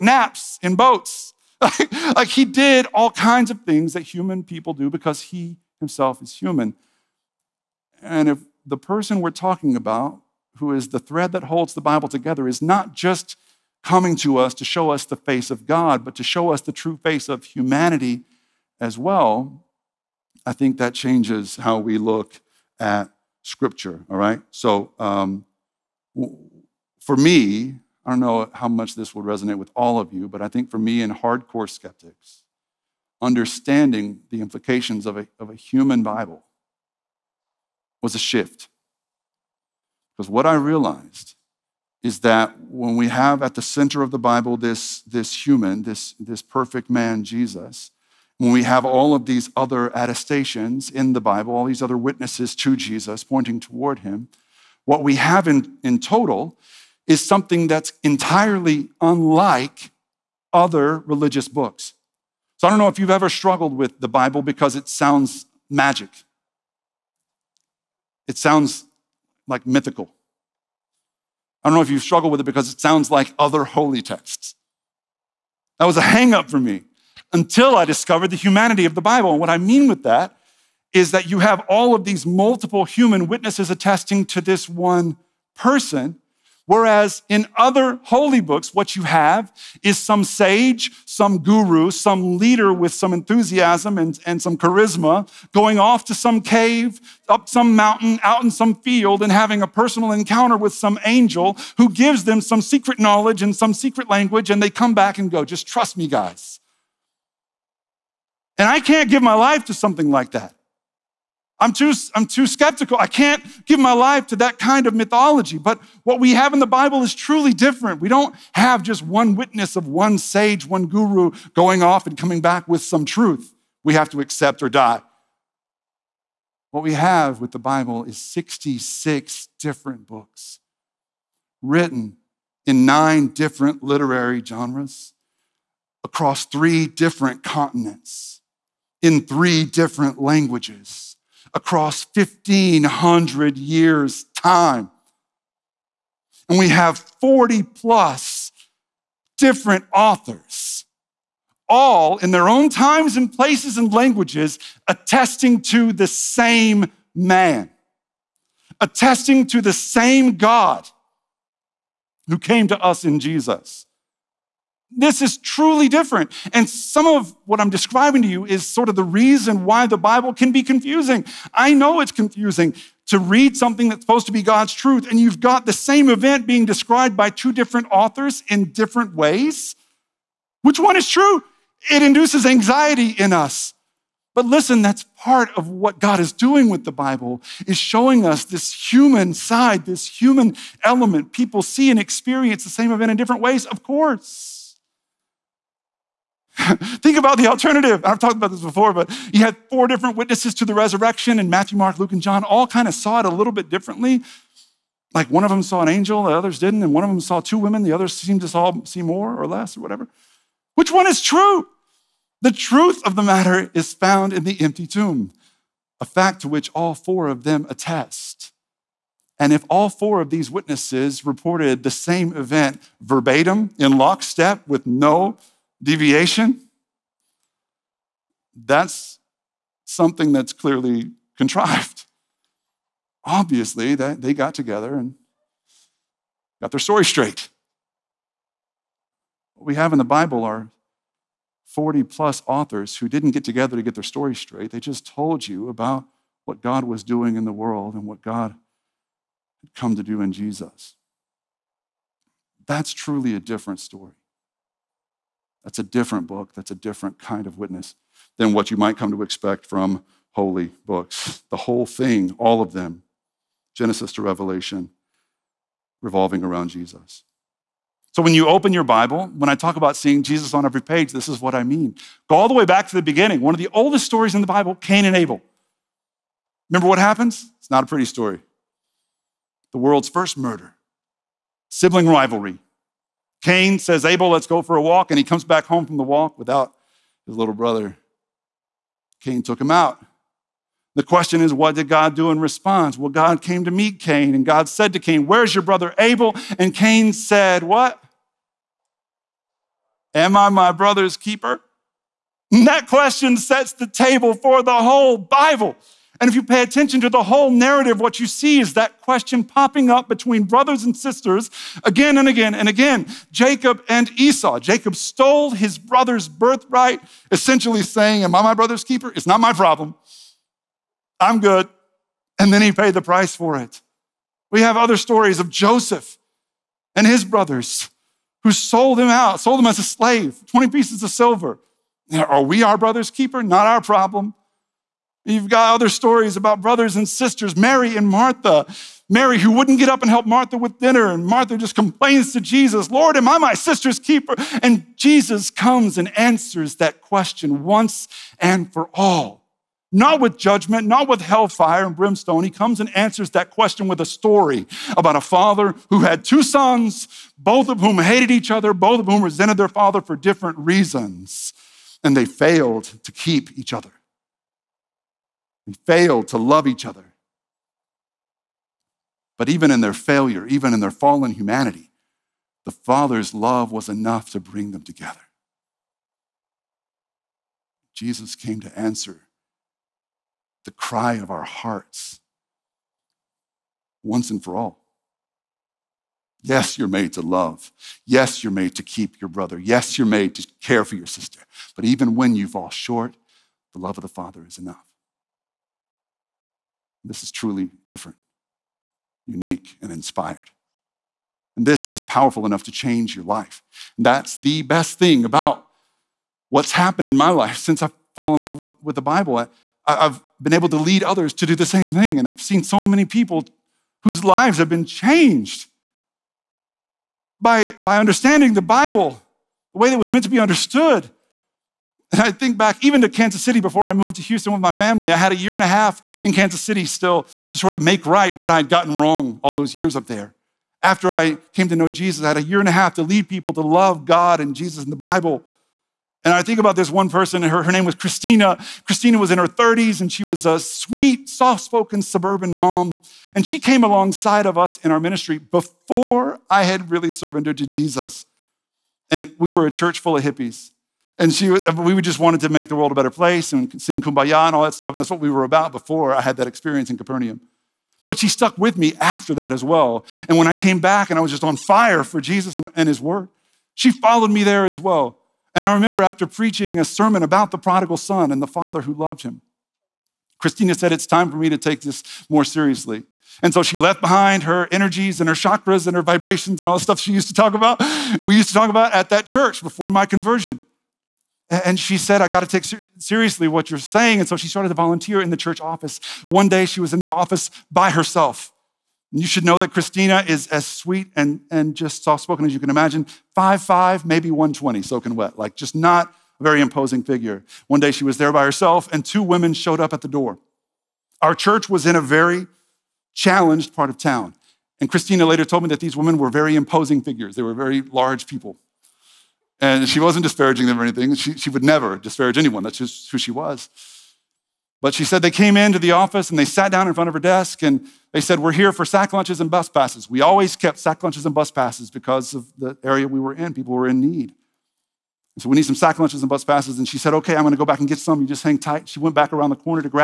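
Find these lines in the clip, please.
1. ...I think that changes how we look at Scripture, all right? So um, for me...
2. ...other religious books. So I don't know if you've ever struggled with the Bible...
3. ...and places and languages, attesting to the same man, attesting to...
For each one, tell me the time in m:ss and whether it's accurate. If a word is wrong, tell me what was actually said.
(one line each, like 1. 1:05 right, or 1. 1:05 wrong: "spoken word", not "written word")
1. 0:20 right
2. 1:00 right
3. 2:33 right.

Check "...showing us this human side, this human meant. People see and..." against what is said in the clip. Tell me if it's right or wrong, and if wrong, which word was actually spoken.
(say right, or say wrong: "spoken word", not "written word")
wrong: "element", not "meant".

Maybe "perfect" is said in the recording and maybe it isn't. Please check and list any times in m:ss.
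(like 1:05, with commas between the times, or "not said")
0:46.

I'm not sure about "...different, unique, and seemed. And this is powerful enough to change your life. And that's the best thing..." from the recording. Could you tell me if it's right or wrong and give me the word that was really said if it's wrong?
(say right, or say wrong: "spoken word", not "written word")
wrong: "inspired", not "seemed".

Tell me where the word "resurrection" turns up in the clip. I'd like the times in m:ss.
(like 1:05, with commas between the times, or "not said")
3:20.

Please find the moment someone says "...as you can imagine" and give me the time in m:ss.
8:12.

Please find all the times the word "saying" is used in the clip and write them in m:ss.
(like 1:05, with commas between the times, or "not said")
5:17, 8:03.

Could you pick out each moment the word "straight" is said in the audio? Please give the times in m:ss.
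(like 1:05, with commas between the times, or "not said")
3:57, 4:04.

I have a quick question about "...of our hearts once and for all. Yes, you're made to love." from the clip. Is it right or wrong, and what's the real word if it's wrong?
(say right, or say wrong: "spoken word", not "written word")
right.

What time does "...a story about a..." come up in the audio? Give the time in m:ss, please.
5:54.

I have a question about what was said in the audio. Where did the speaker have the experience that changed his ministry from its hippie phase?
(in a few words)
Capernaum.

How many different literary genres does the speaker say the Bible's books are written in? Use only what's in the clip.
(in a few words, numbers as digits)
9.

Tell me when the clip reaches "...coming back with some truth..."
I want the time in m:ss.
2:02.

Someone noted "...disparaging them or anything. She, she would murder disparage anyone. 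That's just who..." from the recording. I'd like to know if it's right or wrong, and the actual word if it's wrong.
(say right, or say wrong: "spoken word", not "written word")
wrong: "never", not "murder".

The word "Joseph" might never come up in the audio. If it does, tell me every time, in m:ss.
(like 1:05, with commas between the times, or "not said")
5:25.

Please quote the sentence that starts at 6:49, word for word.
I, I've been able to lead others to do the same thing.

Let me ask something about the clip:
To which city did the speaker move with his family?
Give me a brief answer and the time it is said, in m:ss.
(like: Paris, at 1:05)
Houston, at 7:04.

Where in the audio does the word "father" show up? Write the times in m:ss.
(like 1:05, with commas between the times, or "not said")
5:55, 5:59, 6:12, 6:34, 7:48.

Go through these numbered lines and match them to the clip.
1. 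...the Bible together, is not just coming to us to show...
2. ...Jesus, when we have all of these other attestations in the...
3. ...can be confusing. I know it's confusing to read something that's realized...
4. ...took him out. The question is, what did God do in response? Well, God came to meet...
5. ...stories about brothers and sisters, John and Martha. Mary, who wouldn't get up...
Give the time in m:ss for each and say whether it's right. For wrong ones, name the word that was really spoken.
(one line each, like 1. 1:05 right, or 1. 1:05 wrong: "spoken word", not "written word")
1. 0:11 right
2. 0:47 right
3. 2:50 wrong: "supposed", not "realized"
4. 4:49 right
5. 5:35 wrong: "Mary", not "John".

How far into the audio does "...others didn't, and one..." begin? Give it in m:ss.
3:26.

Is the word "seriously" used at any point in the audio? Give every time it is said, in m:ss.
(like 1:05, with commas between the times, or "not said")
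7:52, 8:02.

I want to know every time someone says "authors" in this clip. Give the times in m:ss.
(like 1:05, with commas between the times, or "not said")
2:29, 2:57, 4:02.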